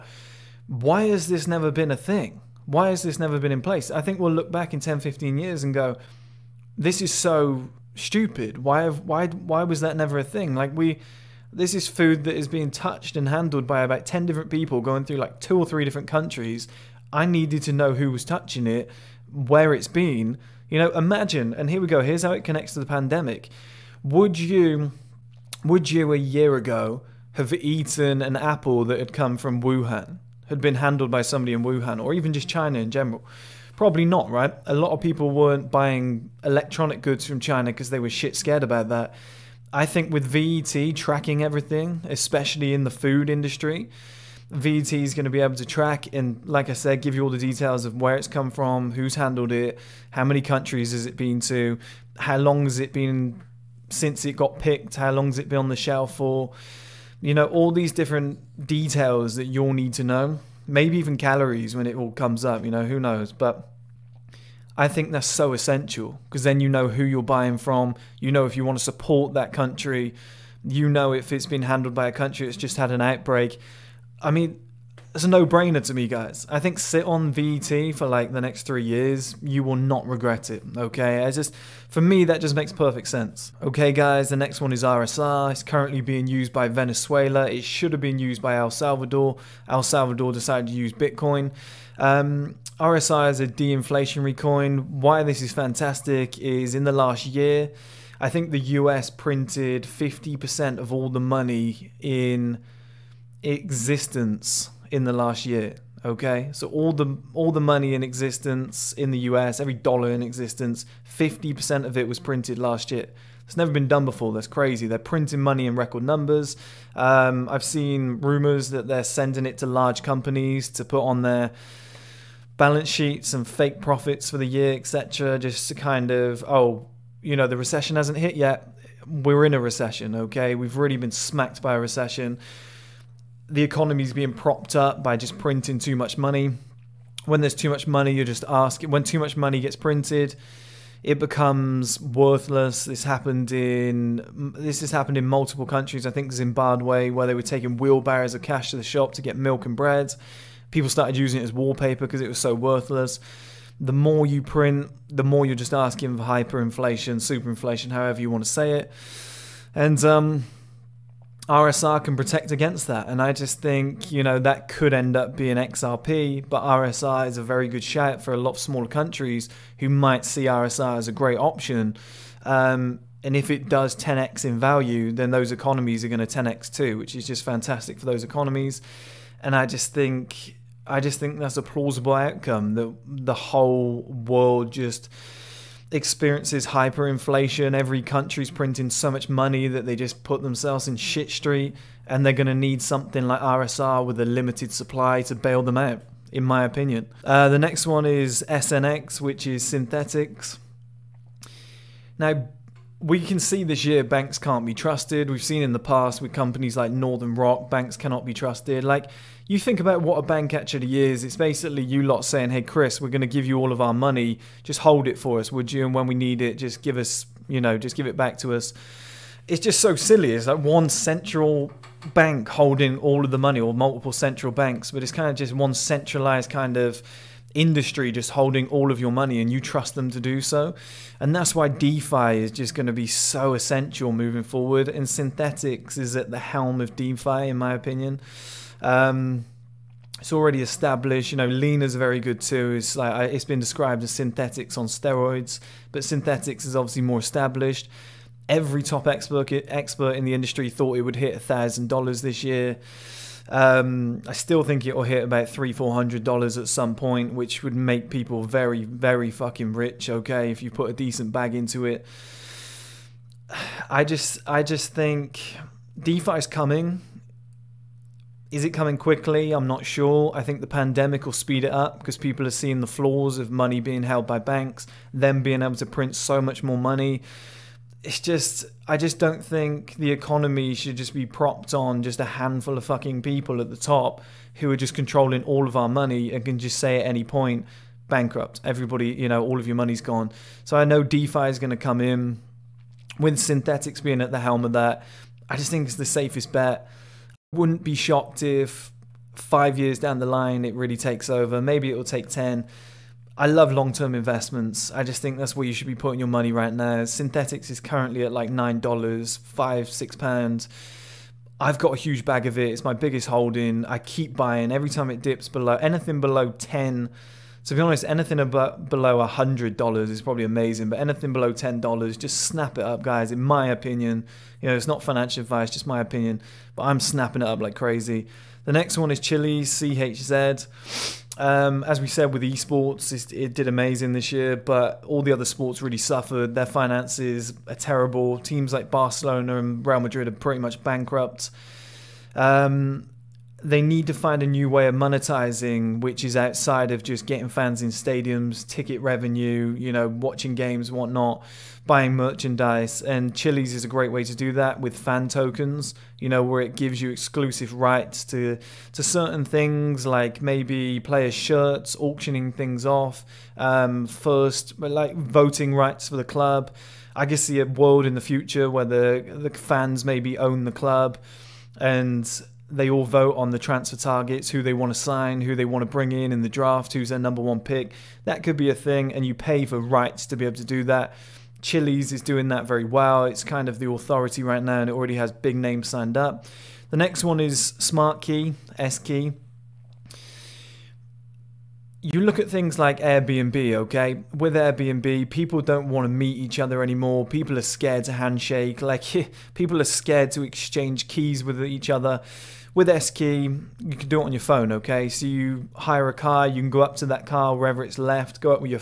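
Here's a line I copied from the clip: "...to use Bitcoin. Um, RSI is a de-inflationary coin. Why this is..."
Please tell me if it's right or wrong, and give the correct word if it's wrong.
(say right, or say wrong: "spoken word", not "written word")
right.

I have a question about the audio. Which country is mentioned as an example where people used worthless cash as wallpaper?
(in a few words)
Zimbabwe.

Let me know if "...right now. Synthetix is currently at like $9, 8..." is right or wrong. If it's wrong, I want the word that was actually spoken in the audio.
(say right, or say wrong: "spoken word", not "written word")
wrong: "5", not "8".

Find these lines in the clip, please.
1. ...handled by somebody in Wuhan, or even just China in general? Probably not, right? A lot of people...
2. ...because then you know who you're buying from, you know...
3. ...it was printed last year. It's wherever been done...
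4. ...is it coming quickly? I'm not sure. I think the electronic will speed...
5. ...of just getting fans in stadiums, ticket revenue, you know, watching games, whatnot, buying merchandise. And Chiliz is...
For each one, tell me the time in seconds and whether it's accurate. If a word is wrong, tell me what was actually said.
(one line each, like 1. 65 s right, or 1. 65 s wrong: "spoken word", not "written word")
1. 30 s right
2. 66 s right
3. 111 s wrong: "never", not "wherever"
4. 268 s wrong: "pandemic", not "electronic"
5. 346 s right.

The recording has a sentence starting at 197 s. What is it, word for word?
Uh, the next one is SNX, which is Synthetix.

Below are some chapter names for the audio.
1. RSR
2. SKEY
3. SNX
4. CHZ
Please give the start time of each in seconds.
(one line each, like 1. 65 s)
1. 82 s
2. 384 s
3. 196 s
4. 327 s.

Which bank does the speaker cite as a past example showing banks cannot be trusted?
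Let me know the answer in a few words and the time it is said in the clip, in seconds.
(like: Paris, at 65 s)
Northern Rock, at 206 s.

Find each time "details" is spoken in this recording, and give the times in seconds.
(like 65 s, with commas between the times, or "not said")
47 s, 58 s.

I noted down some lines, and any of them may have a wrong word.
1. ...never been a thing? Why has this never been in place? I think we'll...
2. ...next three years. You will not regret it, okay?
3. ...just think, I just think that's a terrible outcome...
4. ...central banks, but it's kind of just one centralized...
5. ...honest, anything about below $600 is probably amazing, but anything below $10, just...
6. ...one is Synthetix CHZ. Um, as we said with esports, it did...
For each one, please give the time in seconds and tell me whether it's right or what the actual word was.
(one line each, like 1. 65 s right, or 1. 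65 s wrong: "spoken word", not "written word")
1. 1 s right
2. 78 s right
3. 179 s wrong: "plausible", not "terrible"
4. 224 s right
5. 317 s wrong: "100", not "600"
6. 328 s wrong: "Chiliz", not "Synthetix".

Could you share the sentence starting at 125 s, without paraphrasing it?
Just to kind of, oh, you know, the recession hasn't hit yet.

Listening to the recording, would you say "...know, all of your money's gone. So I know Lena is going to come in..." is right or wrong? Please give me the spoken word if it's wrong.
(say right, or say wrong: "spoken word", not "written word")
wrong: "DeFi", not "Lena".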